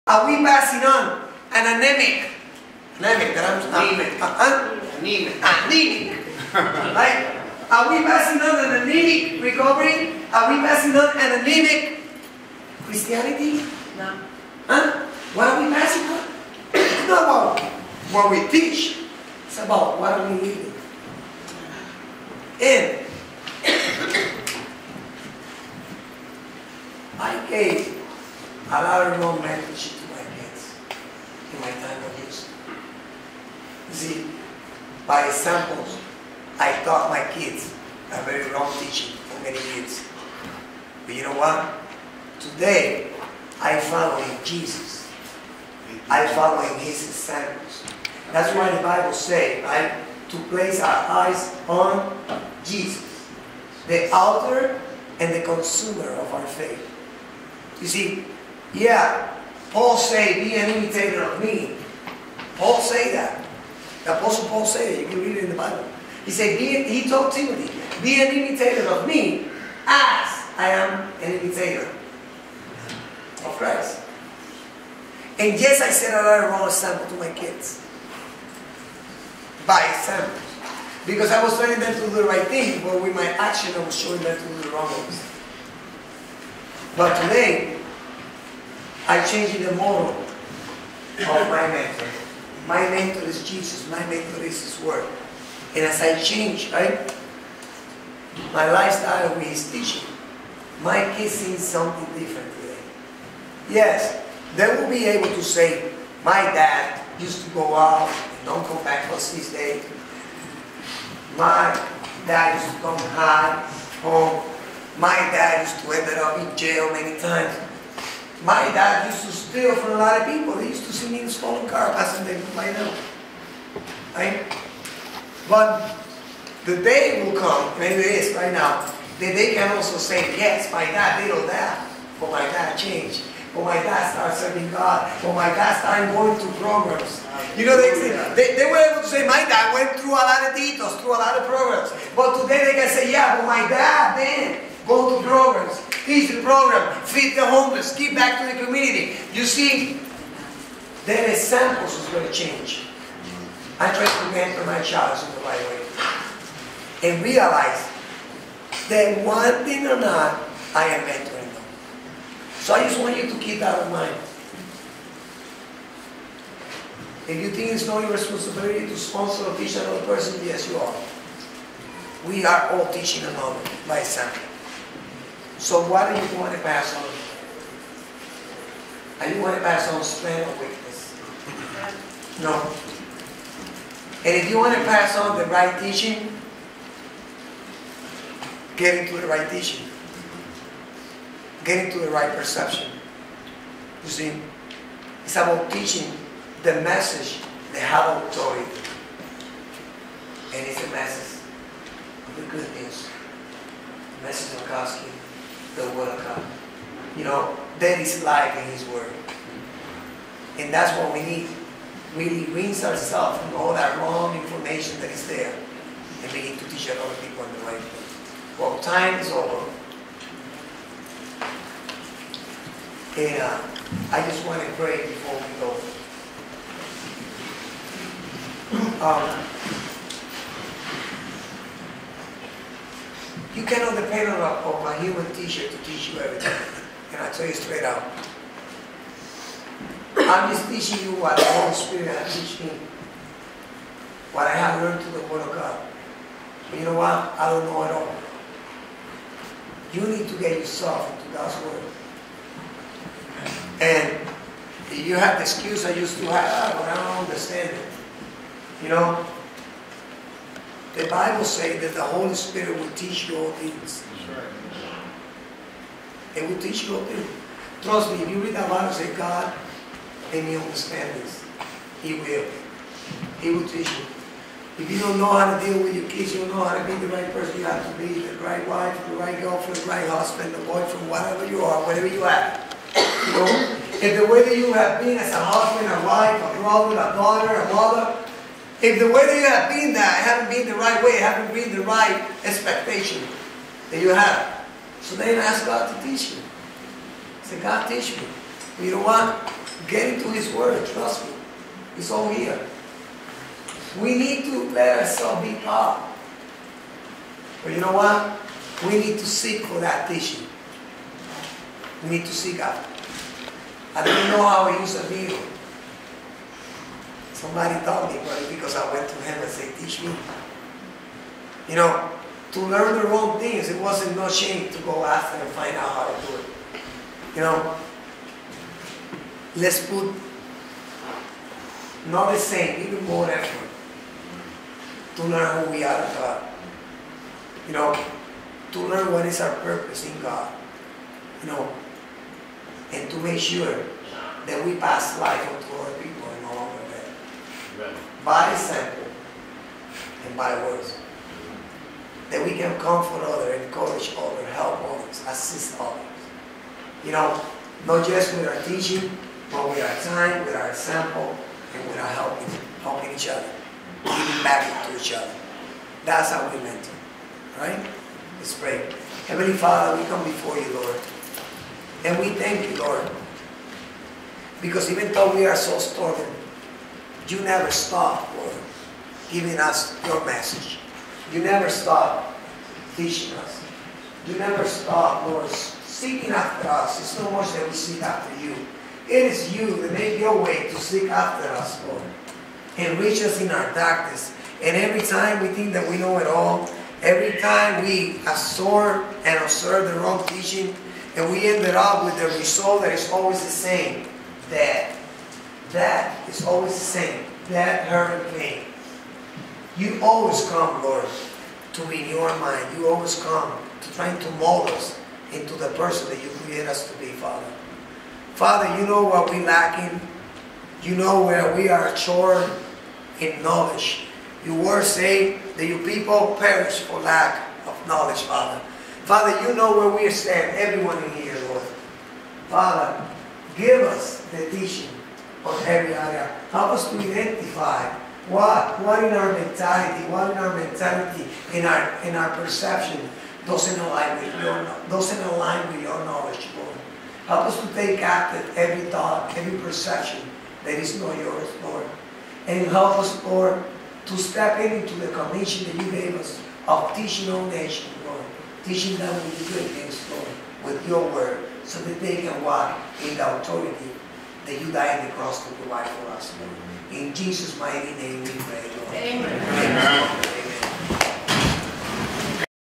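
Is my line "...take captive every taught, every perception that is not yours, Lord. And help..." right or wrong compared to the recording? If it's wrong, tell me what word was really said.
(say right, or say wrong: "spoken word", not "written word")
wrong: "thought", not "taught".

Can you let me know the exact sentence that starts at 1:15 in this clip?
And yes, I set of wrong example to my kids.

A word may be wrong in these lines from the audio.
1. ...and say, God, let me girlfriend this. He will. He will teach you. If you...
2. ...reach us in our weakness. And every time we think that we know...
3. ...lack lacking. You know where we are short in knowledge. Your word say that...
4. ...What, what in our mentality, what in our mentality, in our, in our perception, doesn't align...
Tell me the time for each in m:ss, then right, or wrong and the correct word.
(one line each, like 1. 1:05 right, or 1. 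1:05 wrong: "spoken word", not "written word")
1. 4:28 wrong: "understand", not "girlfriend"
2. 6:32 wrong: "darkness", not "weakness"
3. 6:59 right
4. 7:18 right.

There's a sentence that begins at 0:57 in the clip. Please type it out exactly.
You see, yeah, Paul say, be an imitator of me.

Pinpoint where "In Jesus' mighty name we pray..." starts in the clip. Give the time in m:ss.
7:46.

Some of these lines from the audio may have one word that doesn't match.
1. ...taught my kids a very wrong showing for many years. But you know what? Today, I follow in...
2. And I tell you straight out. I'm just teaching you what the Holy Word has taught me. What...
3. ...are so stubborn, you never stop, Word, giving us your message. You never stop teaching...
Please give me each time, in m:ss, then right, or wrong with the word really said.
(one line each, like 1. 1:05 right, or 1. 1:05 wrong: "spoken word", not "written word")
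1. 0:36 wrong: "teaching", not "showing"
2. 3:57 wrong: "Spirit", not "Word"
3. 6:15 wrong: "Lord", not "Word".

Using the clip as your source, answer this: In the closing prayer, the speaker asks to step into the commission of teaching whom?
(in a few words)
all nations.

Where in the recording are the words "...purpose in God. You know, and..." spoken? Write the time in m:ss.
5:39.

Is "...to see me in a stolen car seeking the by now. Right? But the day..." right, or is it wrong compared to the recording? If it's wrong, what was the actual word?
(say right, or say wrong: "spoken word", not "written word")
wrong: "passing", not "seeking".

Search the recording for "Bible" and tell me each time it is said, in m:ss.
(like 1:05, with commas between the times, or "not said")
0:48, 1:05, 4:21, 4:28.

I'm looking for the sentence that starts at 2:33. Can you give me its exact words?
I tried to mentor my child in the right way and realize that one thing or not, I am mentoring them.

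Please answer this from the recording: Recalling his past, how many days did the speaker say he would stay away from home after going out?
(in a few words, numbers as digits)
6.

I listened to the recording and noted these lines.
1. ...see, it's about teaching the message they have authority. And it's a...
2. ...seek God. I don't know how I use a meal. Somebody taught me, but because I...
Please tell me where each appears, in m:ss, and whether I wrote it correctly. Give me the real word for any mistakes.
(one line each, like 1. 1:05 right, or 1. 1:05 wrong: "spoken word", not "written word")
1. 3:14 right
2. 5:12 right.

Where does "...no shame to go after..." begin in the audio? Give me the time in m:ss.
5:24.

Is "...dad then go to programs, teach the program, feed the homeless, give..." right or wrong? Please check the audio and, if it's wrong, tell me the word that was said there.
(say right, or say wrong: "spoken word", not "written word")
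right.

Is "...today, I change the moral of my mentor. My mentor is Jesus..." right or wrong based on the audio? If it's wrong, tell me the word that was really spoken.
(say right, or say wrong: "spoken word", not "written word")
right.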